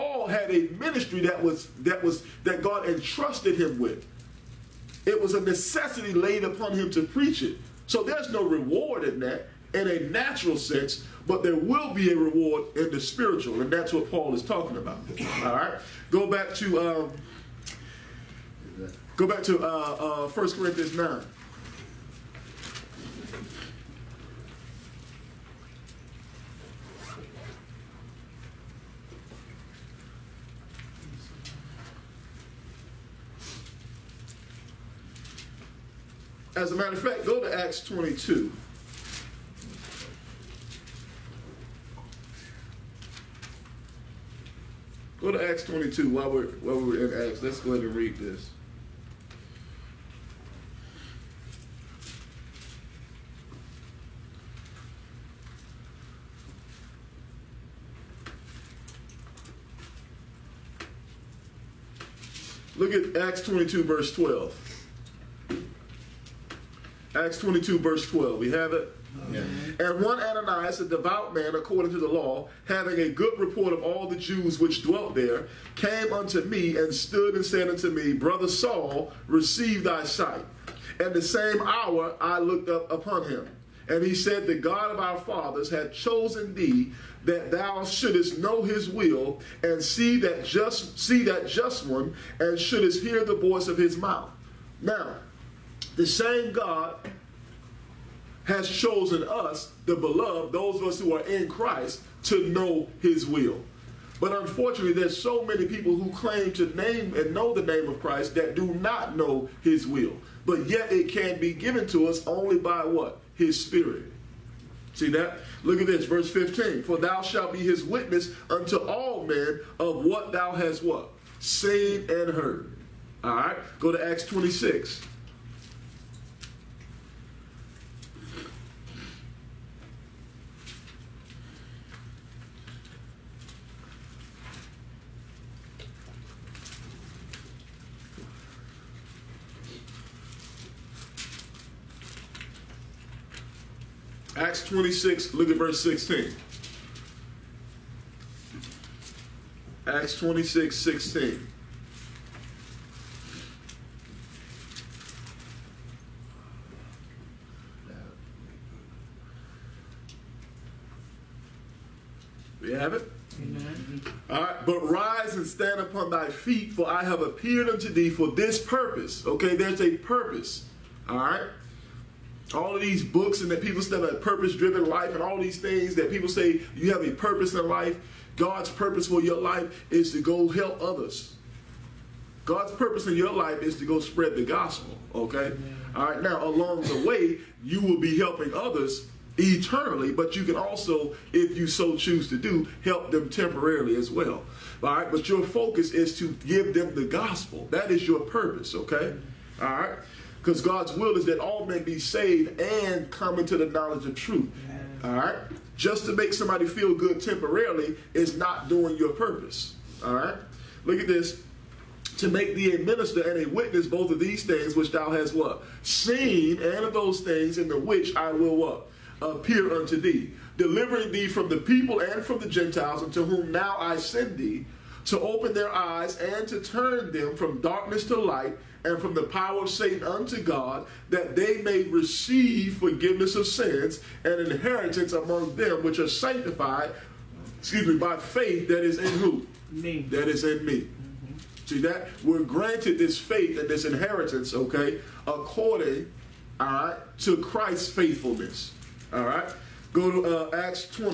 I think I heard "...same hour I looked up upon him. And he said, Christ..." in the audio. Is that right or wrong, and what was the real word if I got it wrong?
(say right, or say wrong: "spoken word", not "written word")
wrong: "The", not "Christ".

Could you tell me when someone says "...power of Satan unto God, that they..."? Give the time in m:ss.
3:49.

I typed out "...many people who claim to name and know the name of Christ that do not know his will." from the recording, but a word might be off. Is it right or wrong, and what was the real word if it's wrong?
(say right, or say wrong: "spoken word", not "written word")
right.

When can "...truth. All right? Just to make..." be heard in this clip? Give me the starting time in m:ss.
3:24.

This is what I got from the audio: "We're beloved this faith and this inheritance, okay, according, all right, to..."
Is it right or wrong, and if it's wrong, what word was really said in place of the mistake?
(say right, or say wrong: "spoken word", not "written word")
wrong: "granted", not "beloved".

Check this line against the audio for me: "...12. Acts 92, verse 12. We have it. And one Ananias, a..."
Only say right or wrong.
wrong.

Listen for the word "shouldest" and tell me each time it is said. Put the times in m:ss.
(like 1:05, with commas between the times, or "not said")
1:27, 1:32.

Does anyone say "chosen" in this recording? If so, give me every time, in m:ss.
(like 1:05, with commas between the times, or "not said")
1:25, 1:38.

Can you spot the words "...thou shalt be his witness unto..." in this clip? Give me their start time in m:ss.
1:56.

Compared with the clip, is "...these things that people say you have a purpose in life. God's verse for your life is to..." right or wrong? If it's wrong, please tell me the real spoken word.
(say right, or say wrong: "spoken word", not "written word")
wrong: "purpose", not "verse".